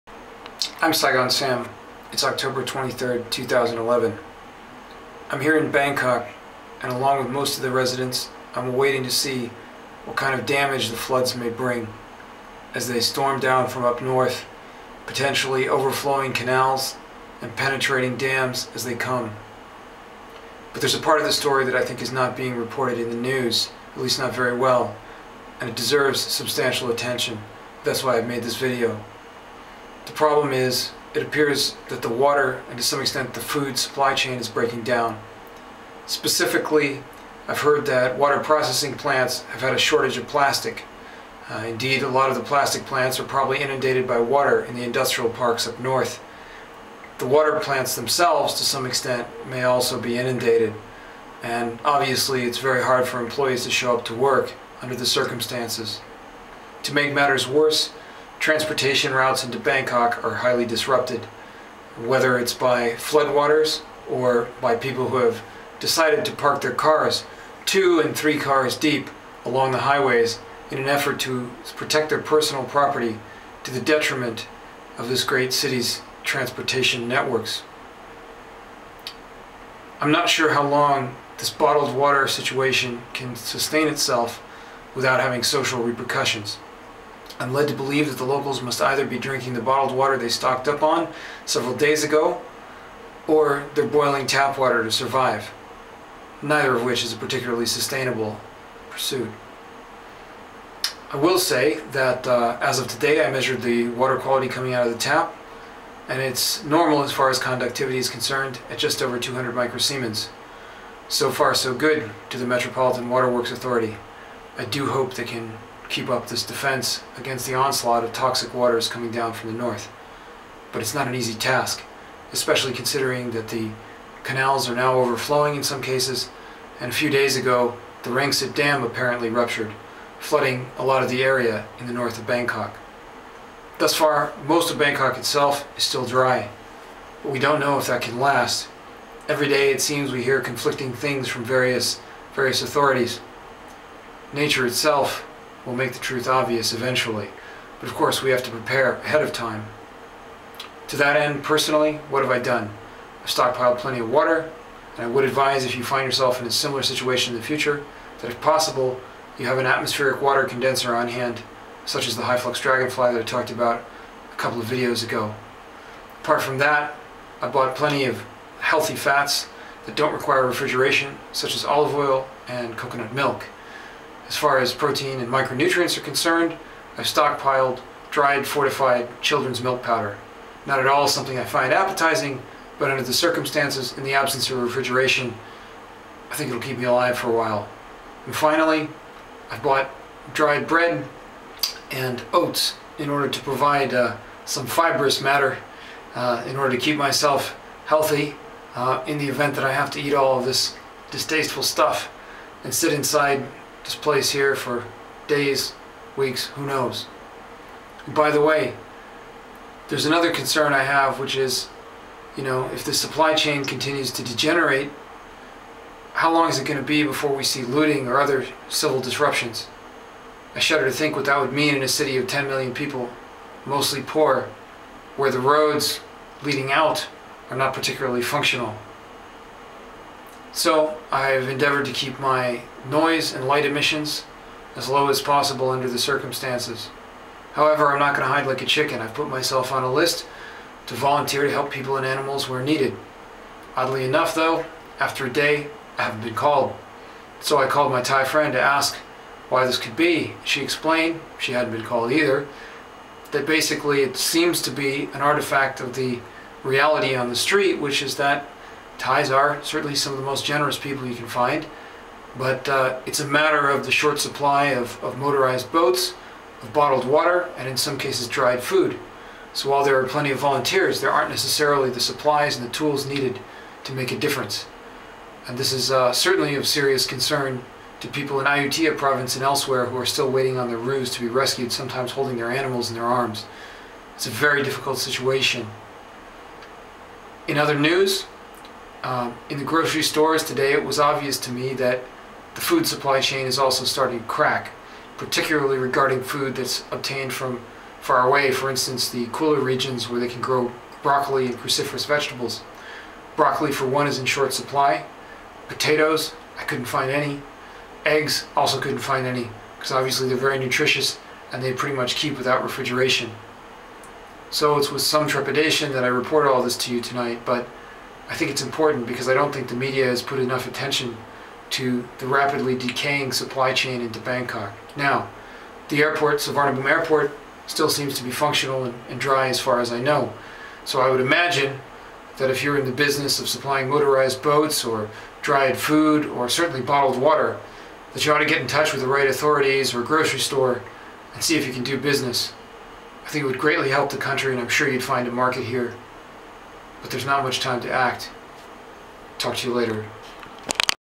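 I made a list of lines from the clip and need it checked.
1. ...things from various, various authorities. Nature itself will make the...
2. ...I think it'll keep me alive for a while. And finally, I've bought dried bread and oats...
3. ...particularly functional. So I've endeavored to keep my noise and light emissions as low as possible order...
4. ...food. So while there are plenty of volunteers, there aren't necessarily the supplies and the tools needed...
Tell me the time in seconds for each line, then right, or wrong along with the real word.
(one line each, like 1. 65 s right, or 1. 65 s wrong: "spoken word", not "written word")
1. 140 s right
2. 186 s right
3. 227 s wrong: "under", not "order"
4. 268 s right.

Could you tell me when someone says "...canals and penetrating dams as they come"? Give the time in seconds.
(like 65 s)
16 s.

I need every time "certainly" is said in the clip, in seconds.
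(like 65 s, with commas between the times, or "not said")
259 s, 276 s, 336 s.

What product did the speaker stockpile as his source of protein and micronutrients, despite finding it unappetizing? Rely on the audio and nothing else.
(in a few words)
fortified children's milk powder.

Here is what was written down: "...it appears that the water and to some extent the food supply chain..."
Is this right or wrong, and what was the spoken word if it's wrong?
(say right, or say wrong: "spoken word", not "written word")
right.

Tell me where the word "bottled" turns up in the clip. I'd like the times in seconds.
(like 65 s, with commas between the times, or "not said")
81 s, 89 s, 266 s, 336 s.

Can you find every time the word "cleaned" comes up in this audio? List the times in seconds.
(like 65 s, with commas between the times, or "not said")
not said.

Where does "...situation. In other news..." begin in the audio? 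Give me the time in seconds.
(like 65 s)
284 s.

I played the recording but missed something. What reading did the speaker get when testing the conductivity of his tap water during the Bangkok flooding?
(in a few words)
just over 200 microsiemens.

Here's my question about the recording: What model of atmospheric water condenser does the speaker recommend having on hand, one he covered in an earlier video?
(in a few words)
high flux dragonfly.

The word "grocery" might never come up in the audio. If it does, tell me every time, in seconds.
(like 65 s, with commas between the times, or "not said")
289 s, 340 s.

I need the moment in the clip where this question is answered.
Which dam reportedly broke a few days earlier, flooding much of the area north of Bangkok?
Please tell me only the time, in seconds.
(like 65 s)
128 s.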